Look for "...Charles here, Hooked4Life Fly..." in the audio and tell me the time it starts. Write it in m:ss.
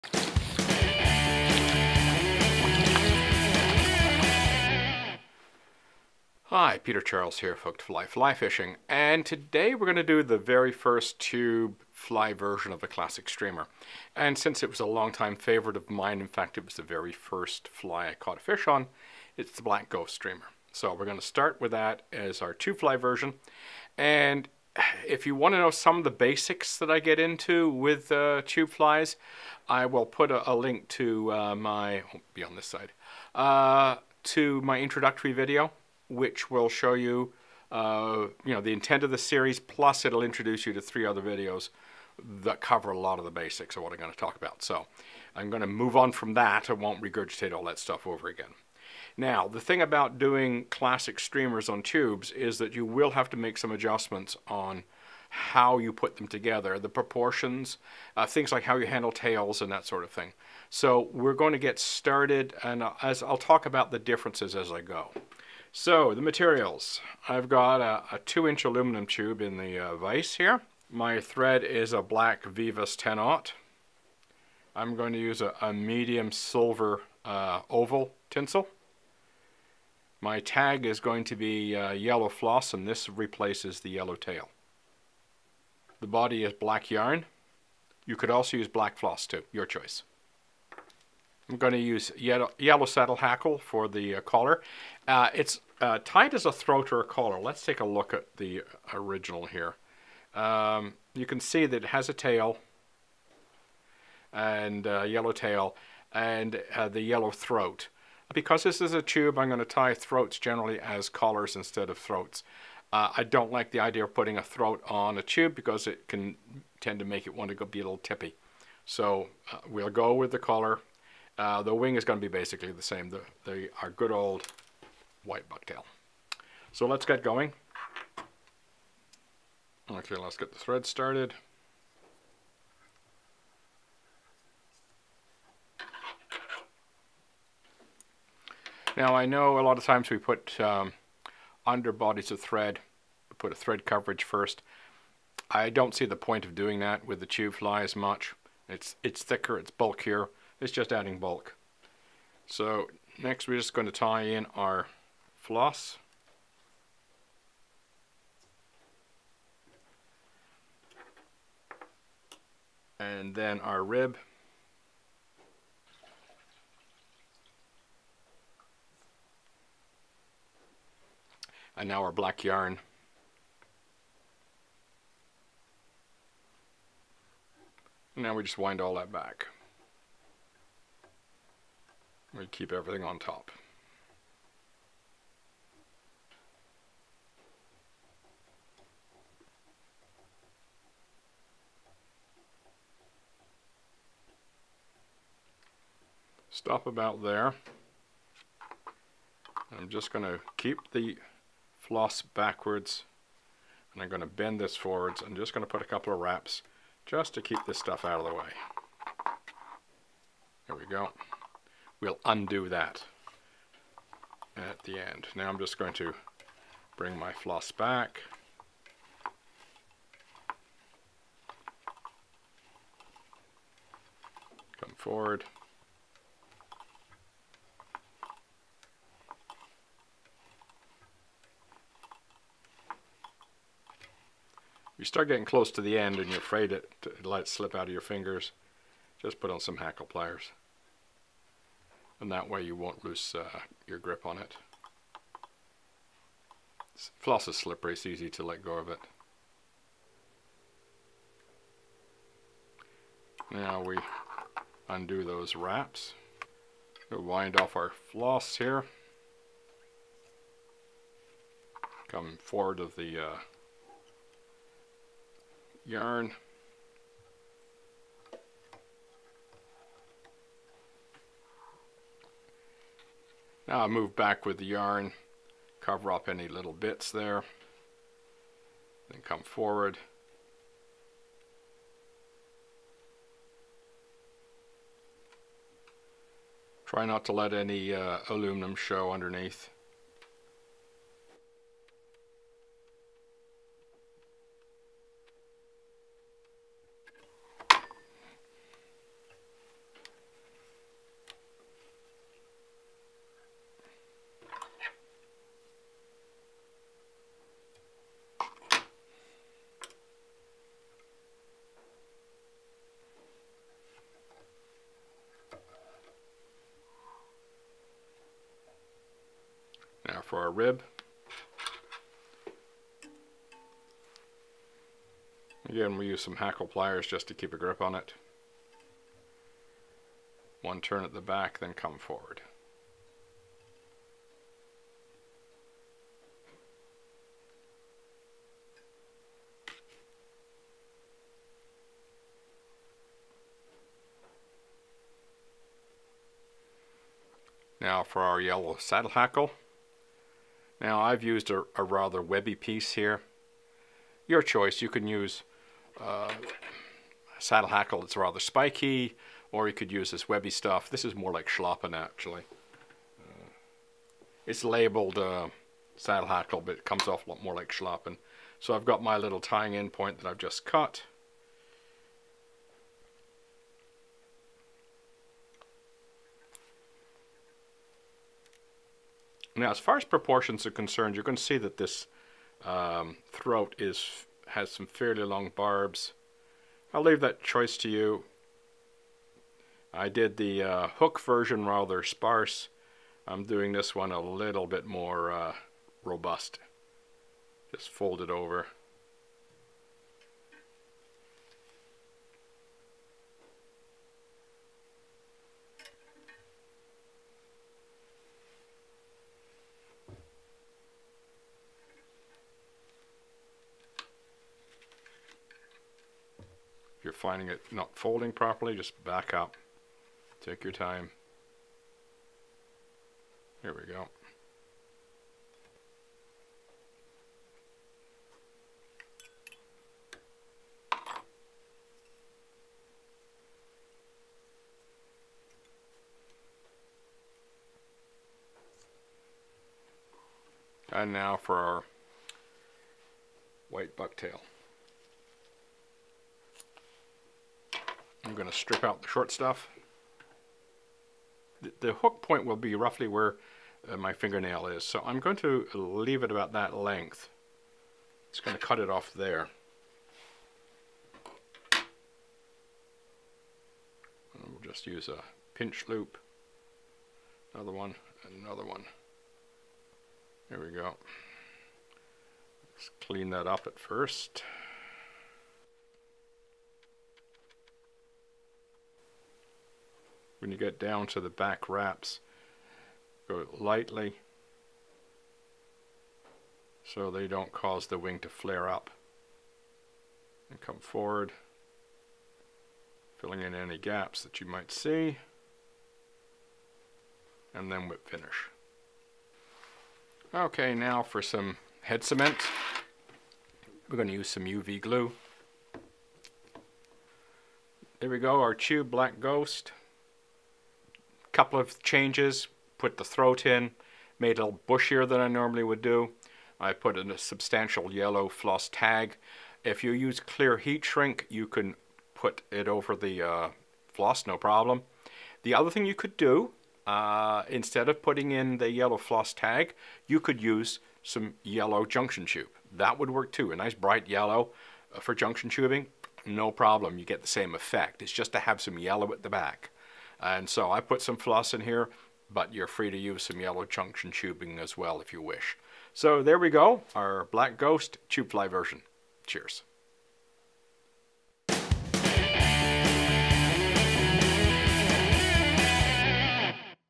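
0:06.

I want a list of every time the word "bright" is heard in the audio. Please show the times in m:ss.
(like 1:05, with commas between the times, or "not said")
8:53.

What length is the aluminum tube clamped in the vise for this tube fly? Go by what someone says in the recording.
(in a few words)
2 inch.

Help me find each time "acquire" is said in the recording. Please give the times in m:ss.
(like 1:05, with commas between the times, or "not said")
not said.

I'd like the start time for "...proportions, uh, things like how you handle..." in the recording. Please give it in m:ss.
0:56.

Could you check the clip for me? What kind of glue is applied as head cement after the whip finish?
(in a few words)
UV glue.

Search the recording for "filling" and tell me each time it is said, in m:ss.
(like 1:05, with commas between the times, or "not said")
8:13.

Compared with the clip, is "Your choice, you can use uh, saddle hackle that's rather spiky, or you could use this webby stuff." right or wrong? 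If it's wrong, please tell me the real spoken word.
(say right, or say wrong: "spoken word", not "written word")
right.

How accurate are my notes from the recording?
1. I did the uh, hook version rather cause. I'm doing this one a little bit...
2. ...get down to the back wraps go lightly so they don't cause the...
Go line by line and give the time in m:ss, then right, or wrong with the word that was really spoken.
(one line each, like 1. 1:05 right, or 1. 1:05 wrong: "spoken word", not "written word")
1. 6:29 wrong: "sparse", not "cause"
2. 8:00 right.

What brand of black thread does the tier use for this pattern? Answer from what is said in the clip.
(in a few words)
Veevus.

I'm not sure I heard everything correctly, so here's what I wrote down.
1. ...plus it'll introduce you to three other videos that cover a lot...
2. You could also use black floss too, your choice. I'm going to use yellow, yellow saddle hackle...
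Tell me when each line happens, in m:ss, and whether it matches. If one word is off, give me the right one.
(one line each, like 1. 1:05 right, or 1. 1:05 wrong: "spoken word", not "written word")
1. 0:39 right
2. 1:28 right.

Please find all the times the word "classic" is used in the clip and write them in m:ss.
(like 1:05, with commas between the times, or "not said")
0:12, 0:50.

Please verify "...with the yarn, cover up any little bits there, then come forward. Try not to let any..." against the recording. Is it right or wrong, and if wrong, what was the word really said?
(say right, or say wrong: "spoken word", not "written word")
right.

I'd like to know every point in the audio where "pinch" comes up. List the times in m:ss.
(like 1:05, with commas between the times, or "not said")
7:45.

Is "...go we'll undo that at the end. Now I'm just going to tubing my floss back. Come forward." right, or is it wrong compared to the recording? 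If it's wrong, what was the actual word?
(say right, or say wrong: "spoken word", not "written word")
wrong: "bring", not "tubing".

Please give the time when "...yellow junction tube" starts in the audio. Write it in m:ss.
8:51.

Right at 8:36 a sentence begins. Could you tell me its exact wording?
I put in a substantial yellow floss tag.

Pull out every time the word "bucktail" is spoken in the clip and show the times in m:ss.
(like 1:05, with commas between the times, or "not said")
2:05, 7:23.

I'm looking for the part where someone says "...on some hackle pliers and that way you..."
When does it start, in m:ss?
3:59.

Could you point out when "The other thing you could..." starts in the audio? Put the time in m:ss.
8:45.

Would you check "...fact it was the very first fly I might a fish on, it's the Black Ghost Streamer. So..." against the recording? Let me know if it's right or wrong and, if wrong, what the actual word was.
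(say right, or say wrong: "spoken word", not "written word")
wrong: "caught", not "might".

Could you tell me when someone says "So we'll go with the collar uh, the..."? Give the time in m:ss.
1:58.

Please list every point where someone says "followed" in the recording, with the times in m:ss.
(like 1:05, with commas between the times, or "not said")
not said.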